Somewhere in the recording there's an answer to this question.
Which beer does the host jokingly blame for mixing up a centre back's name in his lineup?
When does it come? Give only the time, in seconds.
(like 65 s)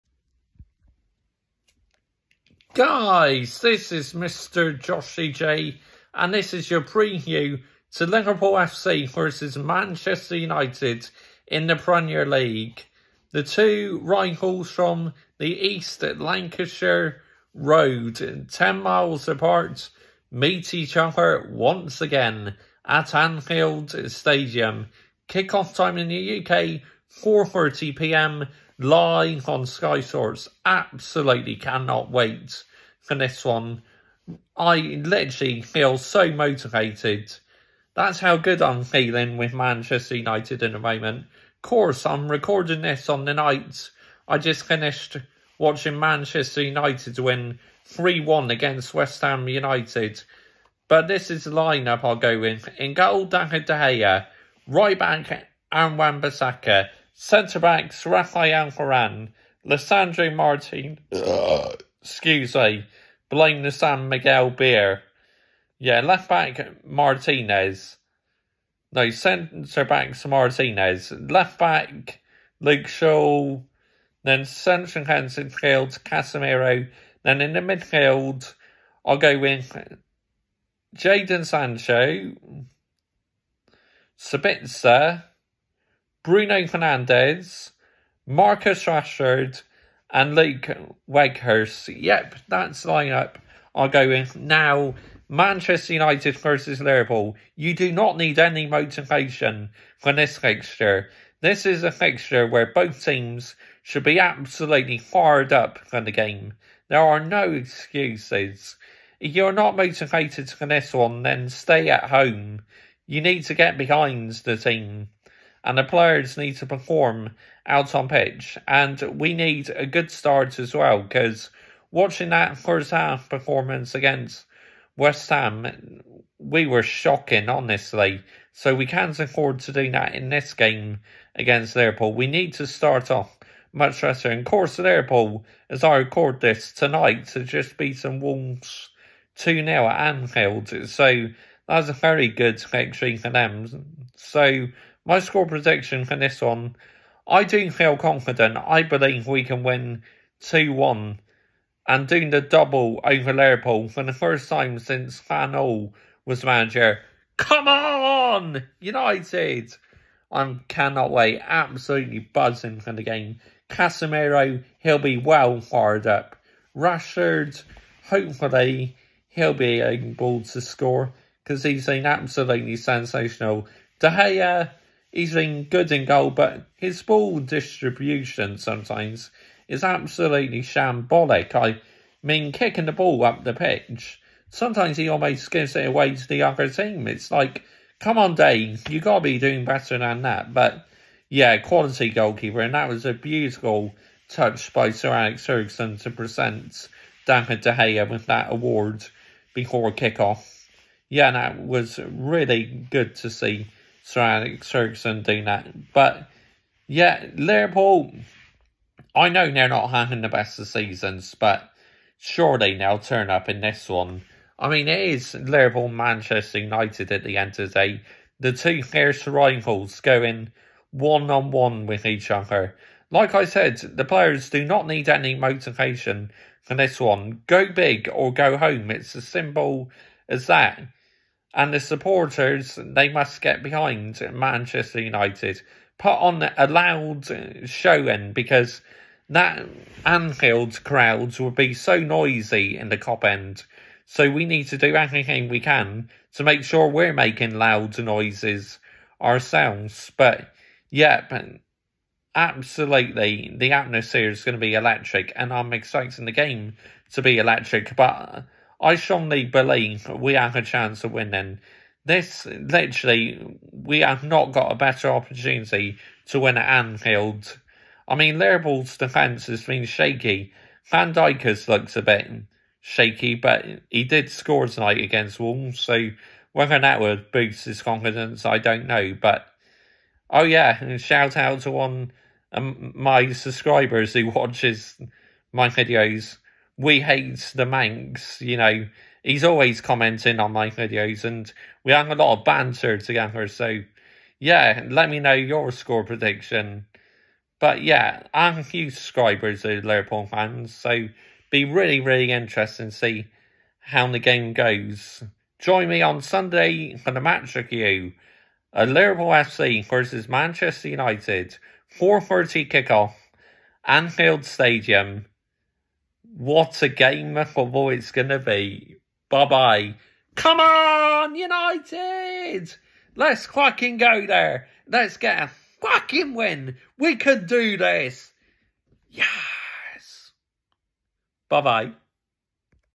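63 s.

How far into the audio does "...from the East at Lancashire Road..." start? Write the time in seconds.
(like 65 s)
14 s.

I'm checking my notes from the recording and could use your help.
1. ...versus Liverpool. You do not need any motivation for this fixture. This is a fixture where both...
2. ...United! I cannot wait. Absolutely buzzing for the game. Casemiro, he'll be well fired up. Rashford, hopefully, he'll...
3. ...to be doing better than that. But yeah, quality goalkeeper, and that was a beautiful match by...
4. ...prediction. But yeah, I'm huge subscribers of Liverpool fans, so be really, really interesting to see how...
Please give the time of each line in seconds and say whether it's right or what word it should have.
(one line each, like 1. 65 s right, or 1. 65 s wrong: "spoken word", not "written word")
1. 96 s right
2. 158 s right
3. 189 s wrong: "touch", not "match"
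4. 296 s right.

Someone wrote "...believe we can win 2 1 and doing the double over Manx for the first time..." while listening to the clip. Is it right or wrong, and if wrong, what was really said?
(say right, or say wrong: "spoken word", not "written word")
wrong: "Liverpool", not "Manx".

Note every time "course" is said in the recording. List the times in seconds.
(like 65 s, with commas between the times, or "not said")
41 s, 134 s.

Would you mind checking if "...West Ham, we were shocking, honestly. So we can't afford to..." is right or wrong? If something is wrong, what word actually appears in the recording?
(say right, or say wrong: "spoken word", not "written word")
right.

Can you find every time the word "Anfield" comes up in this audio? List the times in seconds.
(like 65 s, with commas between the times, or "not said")
23 s, 140 s, 240 s, 266 s, 313 s.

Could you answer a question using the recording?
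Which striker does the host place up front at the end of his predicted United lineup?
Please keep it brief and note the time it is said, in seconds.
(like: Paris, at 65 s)
Weghorst, at 90 s.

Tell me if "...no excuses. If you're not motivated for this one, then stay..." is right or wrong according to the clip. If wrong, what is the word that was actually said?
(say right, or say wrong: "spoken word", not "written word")
right.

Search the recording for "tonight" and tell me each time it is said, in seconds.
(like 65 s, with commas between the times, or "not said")
136 s, 274 s.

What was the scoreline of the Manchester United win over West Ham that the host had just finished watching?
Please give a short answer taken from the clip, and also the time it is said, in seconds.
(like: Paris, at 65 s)
3-1, at 47 s.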